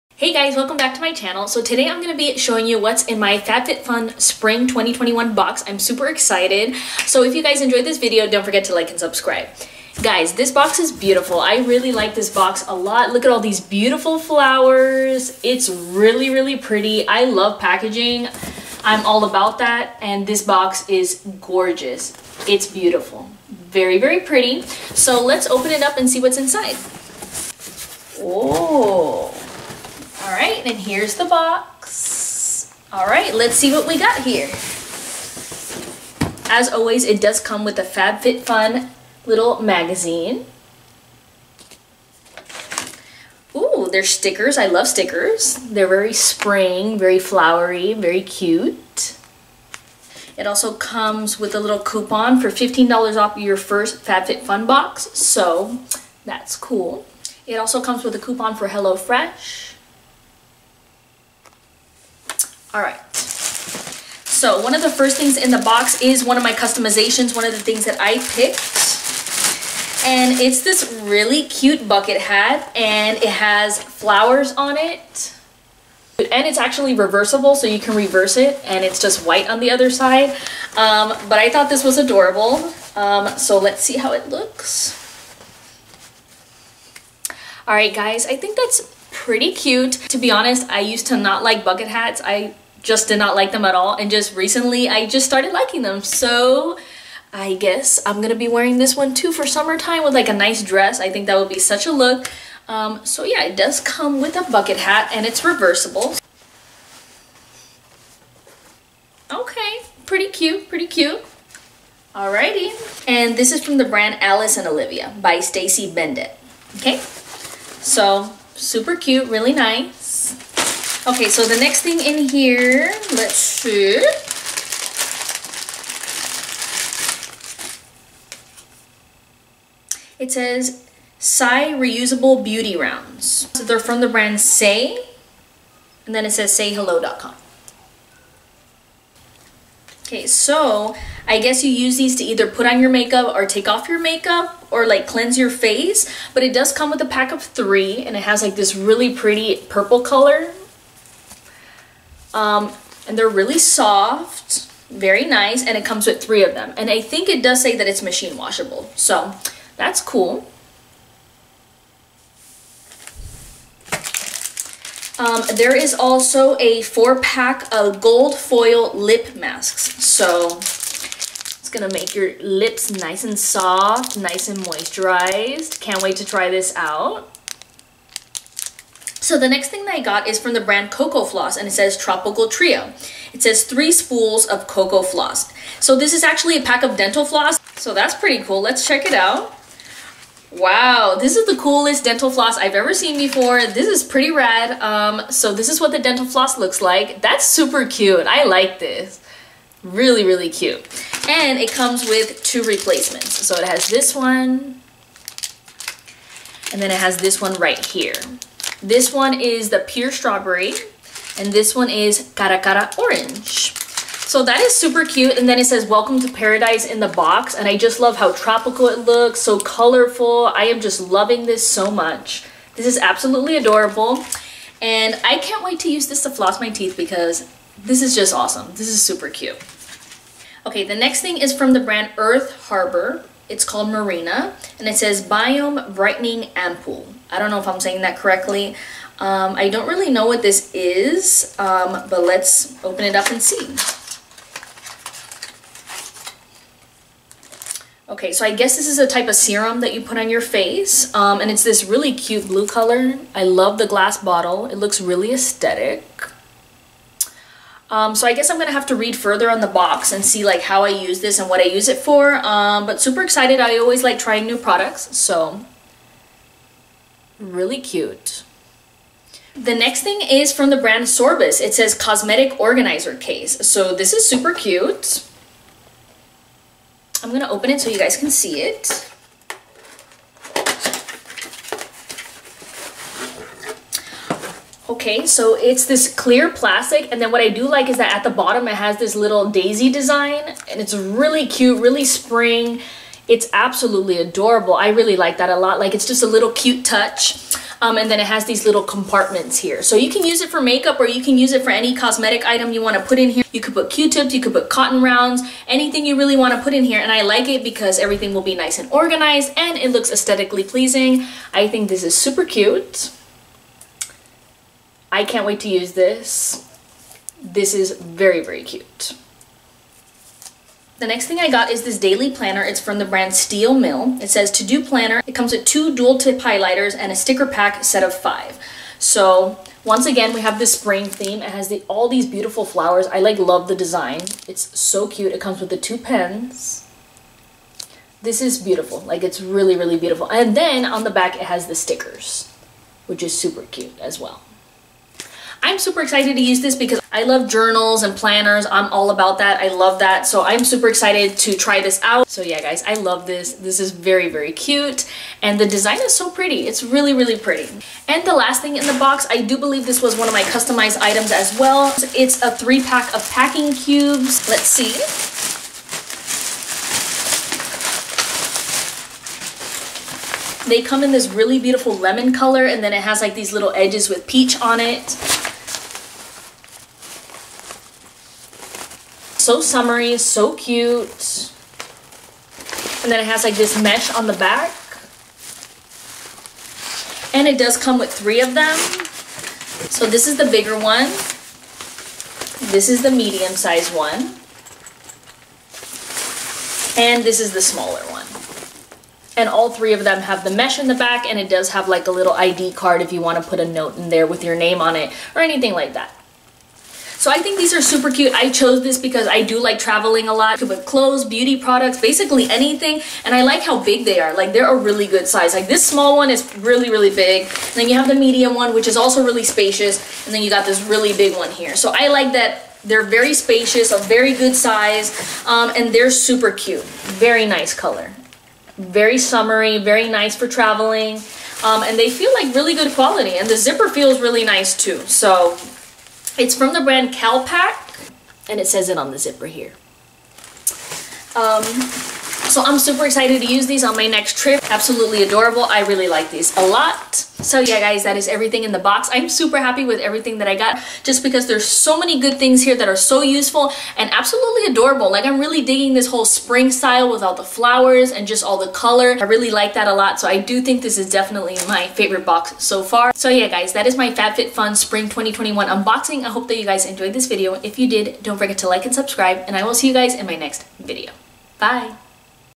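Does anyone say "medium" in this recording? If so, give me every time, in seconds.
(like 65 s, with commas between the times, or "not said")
393 s, 418 s.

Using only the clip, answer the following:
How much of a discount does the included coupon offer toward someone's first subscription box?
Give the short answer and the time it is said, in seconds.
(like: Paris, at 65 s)
$15, at 52 s.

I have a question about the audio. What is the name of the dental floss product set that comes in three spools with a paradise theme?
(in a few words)
Tropical Trio.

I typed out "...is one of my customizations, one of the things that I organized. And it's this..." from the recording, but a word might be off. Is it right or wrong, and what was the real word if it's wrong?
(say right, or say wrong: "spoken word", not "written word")
wrong: "picked", not "organized".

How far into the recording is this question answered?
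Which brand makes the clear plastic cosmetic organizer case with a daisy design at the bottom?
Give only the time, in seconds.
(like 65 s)
271 s.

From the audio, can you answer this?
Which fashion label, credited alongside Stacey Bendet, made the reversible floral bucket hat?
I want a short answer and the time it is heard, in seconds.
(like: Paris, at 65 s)
Alice and Olivia, at 114 s.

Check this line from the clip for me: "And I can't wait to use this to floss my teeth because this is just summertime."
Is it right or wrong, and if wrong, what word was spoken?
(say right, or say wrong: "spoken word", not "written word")
wrong: "awesome", not "summertime".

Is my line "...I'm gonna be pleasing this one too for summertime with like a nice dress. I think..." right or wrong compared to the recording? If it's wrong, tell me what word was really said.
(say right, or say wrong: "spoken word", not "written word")
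wrong: "wearing", not "pleasing".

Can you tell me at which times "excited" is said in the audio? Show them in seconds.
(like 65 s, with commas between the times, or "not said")
6 s, 263 s, 346 s, 350 s, 443 s.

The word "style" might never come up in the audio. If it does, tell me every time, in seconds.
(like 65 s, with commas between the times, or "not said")
456 s.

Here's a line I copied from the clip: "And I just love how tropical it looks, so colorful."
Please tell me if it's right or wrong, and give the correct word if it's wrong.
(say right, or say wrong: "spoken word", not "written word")
right.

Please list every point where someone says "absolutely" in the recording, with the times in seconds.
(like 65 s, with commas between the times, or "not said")
222 s, 293 s, 444 s, 454 s.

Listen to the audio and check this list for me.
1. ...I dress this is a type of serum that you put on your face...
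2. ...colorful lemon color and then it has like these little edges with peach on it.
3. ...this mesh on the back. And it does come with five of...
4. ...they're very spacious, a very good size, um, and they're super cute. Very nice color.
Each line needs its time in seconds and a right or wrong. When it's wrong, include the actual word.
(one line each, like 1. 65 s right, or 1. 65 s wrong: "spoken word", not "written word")
1. 248 s wrong: "guess", not "dress"
2. 371 s wrong: "beautiful", not "colorful"
3. 383 s wrong: "three", not "five"
4. 422 s right.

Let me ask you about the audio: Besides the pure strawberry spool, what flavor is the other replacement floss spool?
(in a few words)
Cara Cara orange.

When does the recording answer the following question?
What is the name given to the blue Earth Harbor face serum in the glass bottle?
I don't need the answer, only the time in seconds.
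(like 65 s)
233 s.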